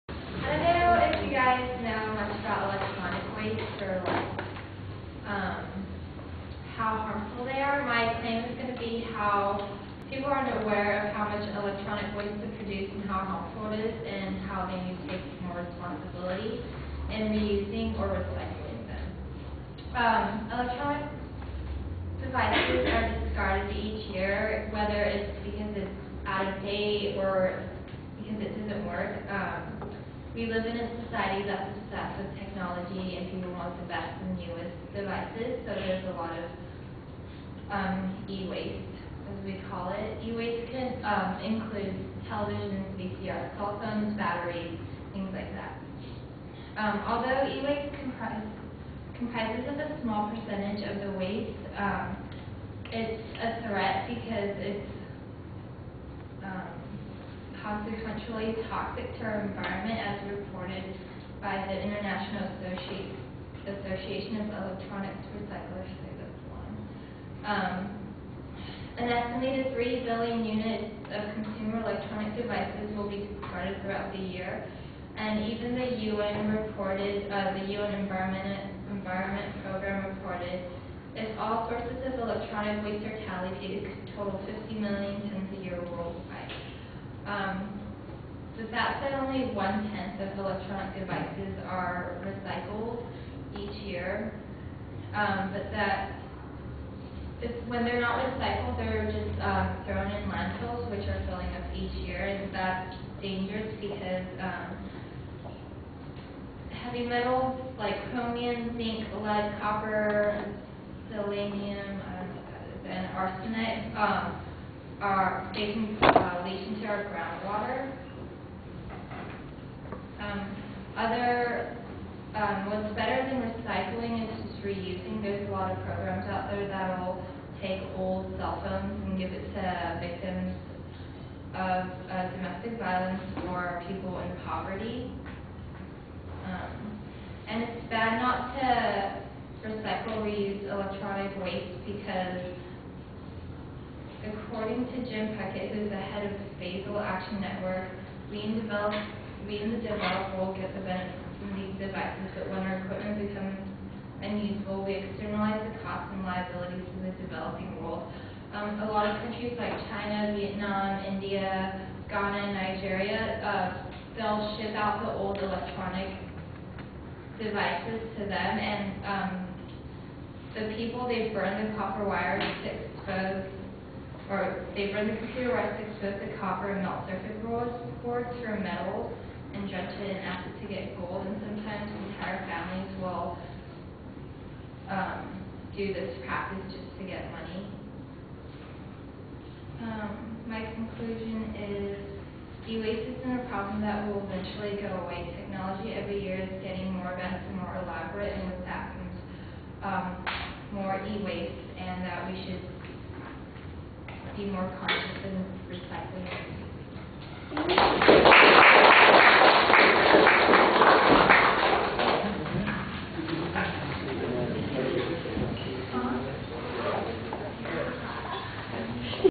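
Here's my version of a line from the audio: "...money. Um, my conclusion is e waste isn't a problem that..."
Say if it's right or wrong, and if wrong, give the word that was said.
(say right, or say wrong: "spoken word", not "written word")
right.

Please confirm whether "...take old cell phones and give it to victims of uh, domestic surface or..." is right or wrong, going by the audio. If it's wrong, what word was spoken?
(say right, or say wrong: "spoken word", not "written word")
wrong: "violence", not "surface".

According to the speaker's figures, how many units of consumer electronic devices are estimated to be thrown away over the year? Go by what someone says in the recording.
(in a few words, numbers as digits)
3 billion.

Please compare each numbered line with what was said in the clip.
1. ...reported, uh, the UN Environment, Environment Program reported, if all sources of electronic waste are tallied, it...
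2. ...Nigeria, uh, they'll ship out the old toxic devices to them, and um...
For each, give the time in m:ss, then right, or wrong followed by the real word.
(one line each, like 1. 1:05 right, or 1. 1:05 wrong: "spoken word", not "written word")
1. 1:16 right
2. 2:42 wrong: "electronic", not "toxic".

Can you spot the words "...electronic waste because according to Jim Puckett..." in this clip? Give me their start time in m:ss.
2:20.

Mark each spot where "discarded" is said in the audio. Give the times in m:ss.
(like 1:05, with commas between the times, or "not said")
0:23, 1:13.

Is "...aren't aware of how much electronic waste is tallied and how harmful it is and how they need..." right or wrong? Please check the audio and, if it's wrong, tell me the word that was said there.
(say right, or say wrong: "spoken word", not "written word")
wrong: "produced", not "tallied".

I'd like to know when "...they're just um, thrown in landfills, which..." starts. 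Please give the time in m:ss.
1:38.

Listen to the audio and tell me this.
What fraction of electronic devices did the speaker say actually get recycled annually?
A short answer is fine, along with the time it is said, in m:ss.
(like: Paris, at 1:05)
one-tenth, at 1:29.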